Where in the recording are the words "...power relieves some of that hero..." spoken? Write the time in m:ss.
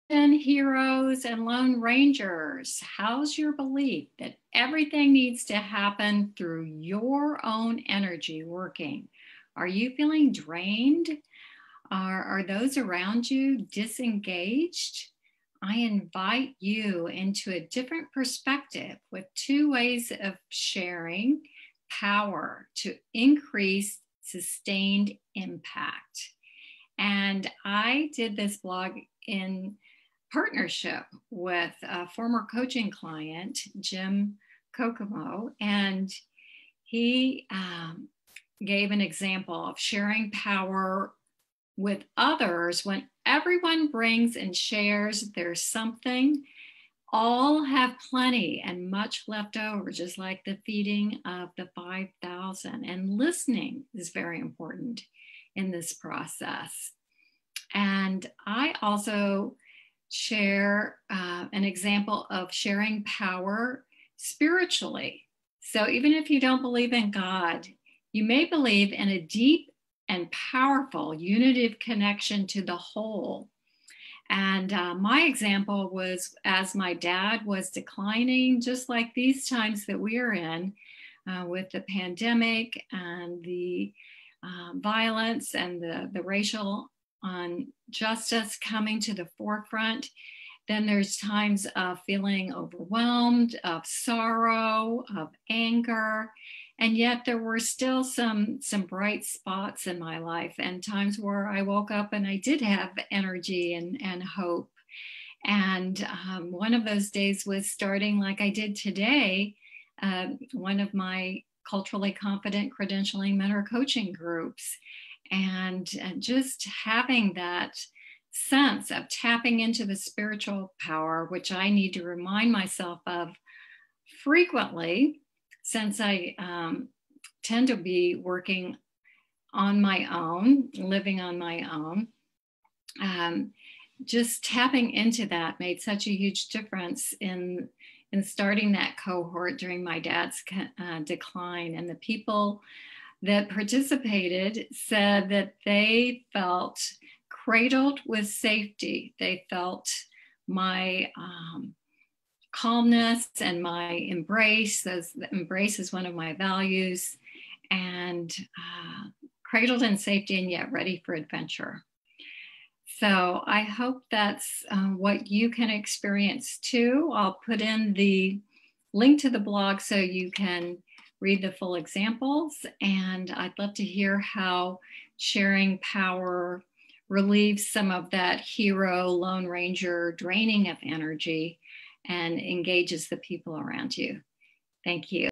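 2:55.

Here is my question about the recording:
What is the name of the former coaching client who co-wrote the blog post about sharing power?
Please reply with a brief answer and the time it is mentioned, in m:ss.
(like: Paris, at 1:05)
Jim Kokomo, at 0:33.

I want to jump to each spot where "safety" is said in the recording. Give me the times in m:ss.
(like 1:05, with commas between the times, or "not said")
2:28, 2:39.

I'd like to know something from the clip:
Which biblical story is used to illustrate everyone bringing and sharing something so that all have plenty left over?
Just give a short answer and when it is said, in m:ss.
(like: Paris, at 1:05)
feeding of the 5,000, at 0:50.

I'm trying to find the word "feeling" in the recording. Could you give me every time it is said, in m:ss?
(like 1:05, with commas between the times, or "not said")
0:09, 1:32.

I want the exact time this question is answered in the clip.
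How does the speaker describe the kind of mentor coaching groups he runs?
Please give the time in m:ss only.
1:51.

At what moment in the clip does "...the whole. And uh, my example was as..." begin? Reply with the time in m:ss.
1:12.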